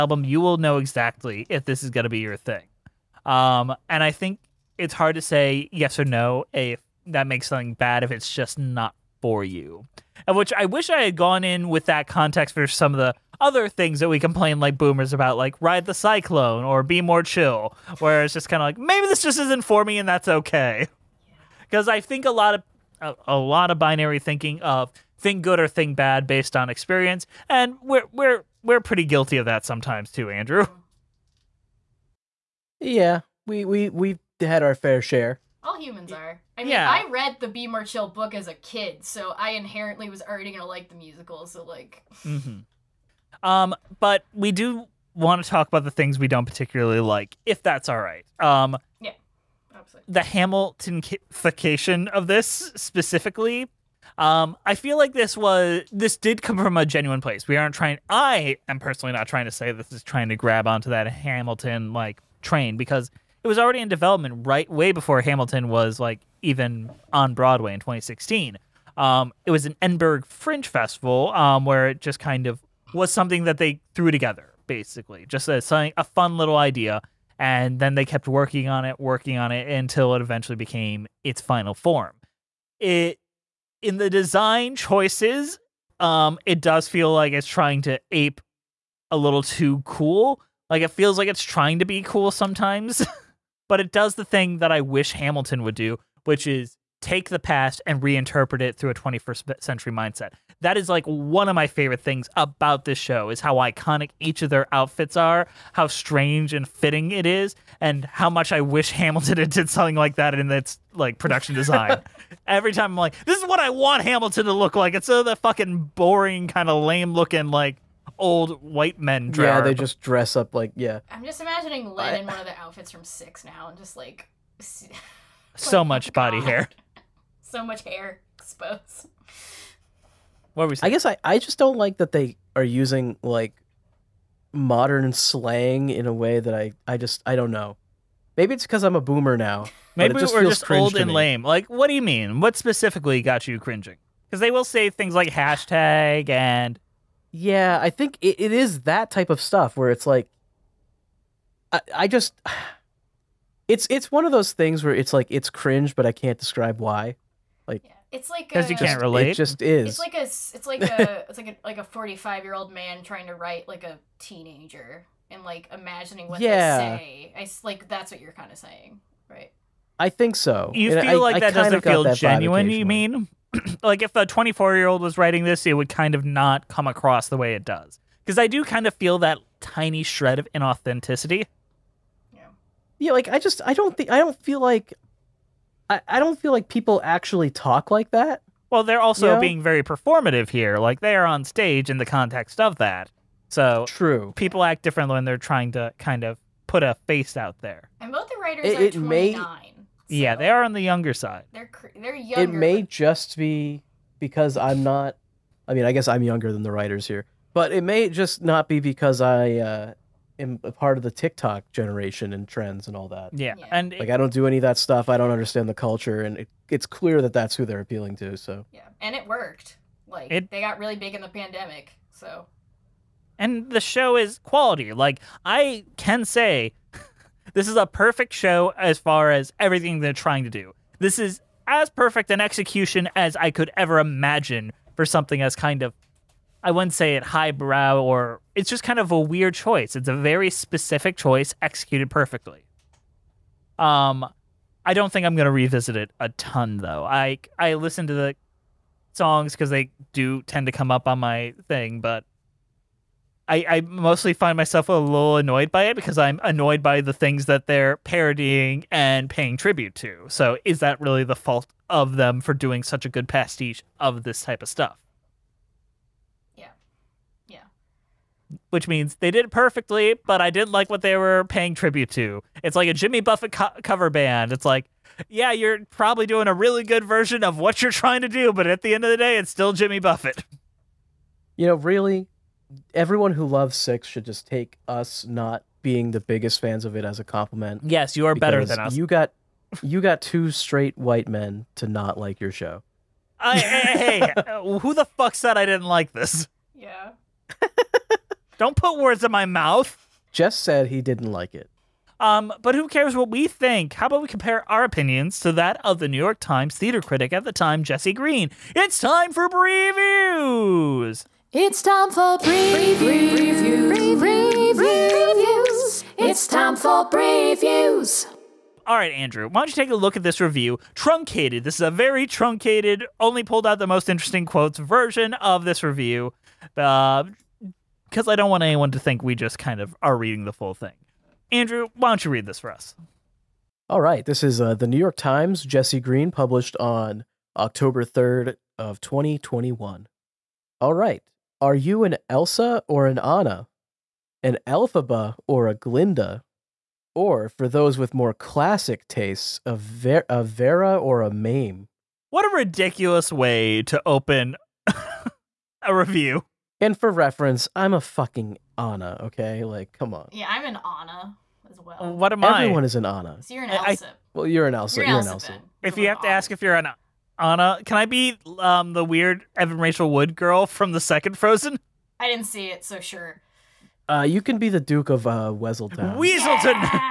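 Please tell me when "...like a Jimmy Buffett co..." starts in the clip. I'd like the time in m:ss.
4:32.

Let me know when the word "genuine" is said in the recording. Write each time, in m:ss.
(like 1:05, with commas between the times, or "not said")
0:56, 2:52.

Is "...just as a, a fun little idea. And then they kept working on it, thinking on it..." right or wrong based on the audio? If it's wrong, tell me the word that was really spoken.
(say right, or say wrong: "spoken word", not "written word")
wrong: "working", not "thinking".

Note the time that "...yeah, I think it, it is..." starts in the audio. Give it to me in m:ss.
2:27.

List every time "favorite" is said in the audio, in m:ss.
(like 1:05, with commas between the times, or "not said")
1:41.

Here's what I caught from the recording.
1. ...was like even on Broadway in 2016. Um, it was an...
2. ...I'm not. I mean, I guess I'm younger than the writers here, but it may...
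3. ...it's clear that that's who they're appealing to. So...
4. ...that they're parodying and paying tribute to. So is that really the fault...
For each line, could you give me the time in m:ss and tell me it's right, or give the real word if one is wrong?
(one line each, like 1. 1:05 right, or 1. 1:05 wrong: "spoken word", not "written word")
1. 1:05 right
2. 3:24 right
3. 3:36 right
4. 4:17 right.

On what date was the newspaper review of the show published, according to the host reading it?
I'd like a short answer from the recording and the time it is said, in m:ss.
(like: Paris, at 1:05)
October 3rd, 2021, at 5:37.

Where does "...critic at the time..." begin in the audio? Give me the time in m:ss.
5:07.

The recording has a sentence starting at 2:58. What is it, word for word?
Because I do kind of feel that tiny shred of inauthenticity.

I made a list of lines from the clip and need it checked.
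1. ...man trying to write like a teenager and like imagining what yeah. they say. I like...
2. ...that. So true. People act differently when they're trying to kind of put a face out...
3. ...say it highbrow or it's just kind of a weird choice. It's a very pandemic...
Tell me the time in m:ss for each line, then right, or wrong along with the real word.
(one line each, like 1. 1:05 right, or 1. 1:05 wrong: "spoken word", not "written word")
1. 2:42 right
2. 3:12 right
3. 3:56 wrong: "specific", not "pandemic".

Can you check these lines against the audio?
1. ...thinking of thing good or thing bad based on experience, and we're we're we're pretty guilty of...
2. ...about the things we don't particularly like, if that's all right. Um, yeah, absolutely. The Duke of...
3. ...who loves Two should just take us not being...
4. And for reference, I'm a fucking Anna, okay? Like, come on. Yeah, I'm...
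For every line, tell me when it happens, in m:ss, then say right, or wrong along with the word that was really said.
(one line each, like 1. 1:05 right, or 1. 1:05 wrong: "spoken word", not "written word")
1. 0:24 right
2. 0:45 wrong: "Hamiltonification", not "Duke"
3. 4:43 wrong: "Six", not "Two"
4. 5:56 right.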